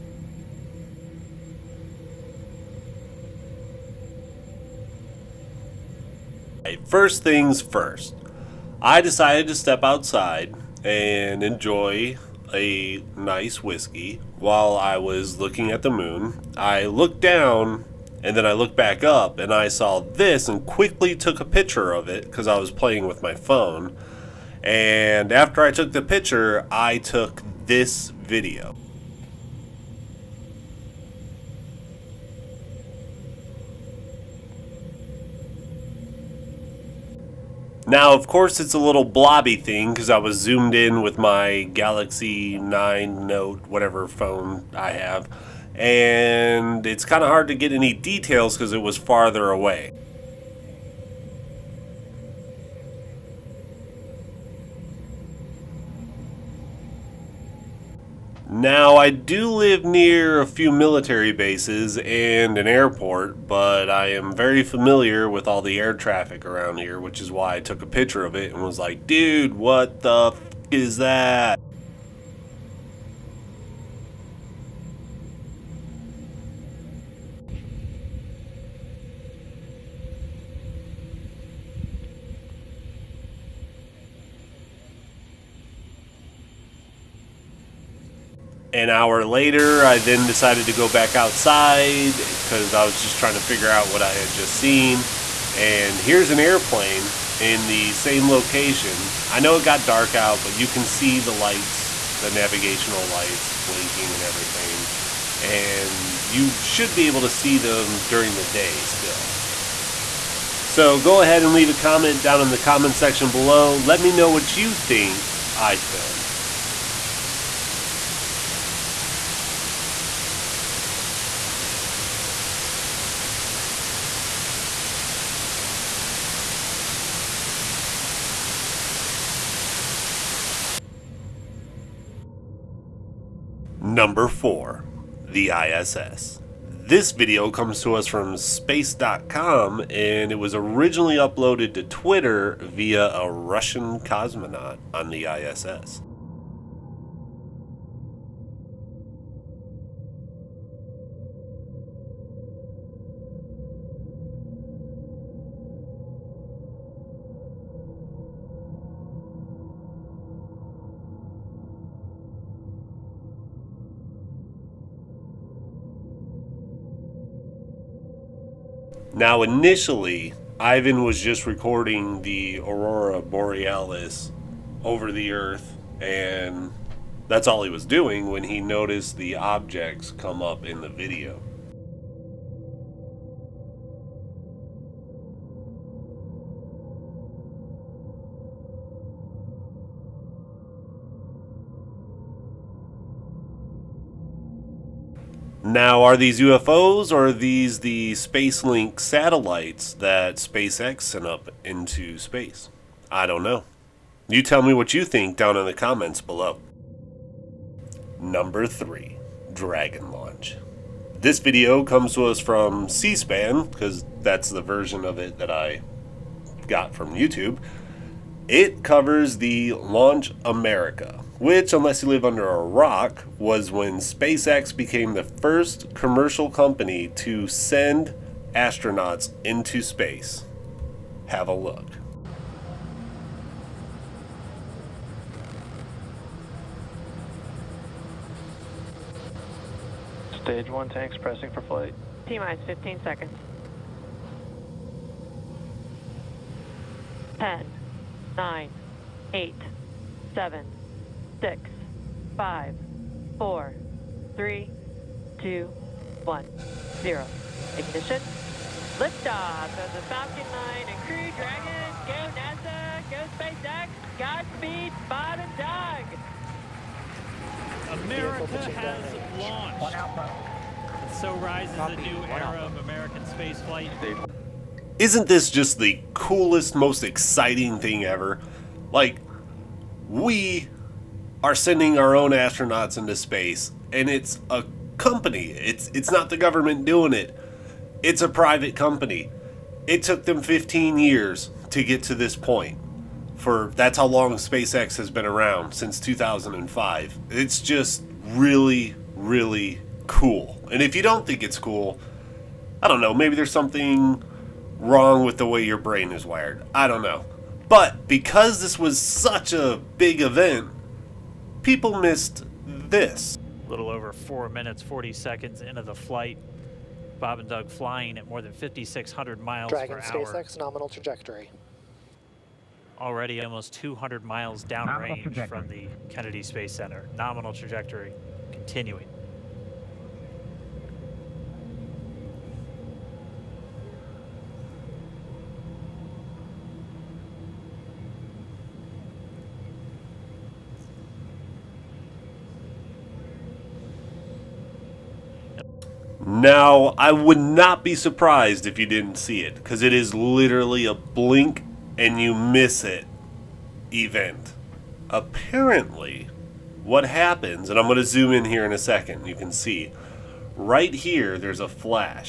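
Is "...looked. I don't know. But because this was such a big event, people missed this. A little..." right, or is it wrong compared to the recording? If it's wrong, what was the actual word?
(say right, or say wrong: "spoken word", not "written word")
wrong: "wired", not "looked".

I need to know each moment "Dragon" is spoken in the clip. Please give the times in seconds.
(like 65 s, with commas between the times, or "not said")
209 s, 261 s, 319 s.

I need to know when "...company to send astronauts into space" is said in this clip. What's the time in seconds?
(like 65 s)
226 s.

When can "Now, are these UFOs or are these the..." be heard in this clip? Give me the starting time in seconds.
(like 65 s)
195 s.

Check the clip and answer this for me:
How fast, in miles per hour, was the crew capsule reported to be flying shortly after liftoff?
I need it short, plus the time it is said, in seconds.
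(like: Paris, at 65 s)
5,600, at 318 s.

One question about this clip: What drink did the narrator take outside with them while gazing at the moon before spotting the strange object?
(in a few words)
whiskey.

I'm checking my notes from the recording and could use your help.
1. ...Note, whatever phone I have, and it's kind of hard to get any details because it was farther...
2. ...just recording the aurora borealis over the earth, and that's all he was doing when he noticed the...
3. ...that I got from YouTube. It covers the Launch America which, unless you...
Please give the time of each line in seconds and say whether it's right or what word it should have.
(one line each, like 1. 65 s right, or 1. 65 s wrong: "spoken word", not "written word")
1. 43 s right
2. 171 s right
3. 215 s right.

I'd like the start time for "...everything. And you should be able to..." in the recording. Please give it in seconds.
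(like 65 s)
104 s.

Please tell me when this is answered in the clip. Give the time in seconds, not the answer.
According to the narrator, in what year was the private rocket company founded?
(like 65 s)
295 s.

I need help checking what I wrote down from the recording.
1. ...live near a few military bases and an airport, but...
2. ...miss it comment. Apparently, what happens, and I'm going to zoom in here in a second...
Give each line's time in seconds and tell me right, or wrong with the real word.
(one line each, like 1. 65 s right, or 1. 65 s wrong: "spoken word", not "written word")
1. 59 s right
2. 352 s wrong: "event", not "comment".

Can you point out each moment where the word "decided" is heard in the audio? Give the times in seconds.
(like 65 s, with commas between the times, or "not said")
9 s, 90 s.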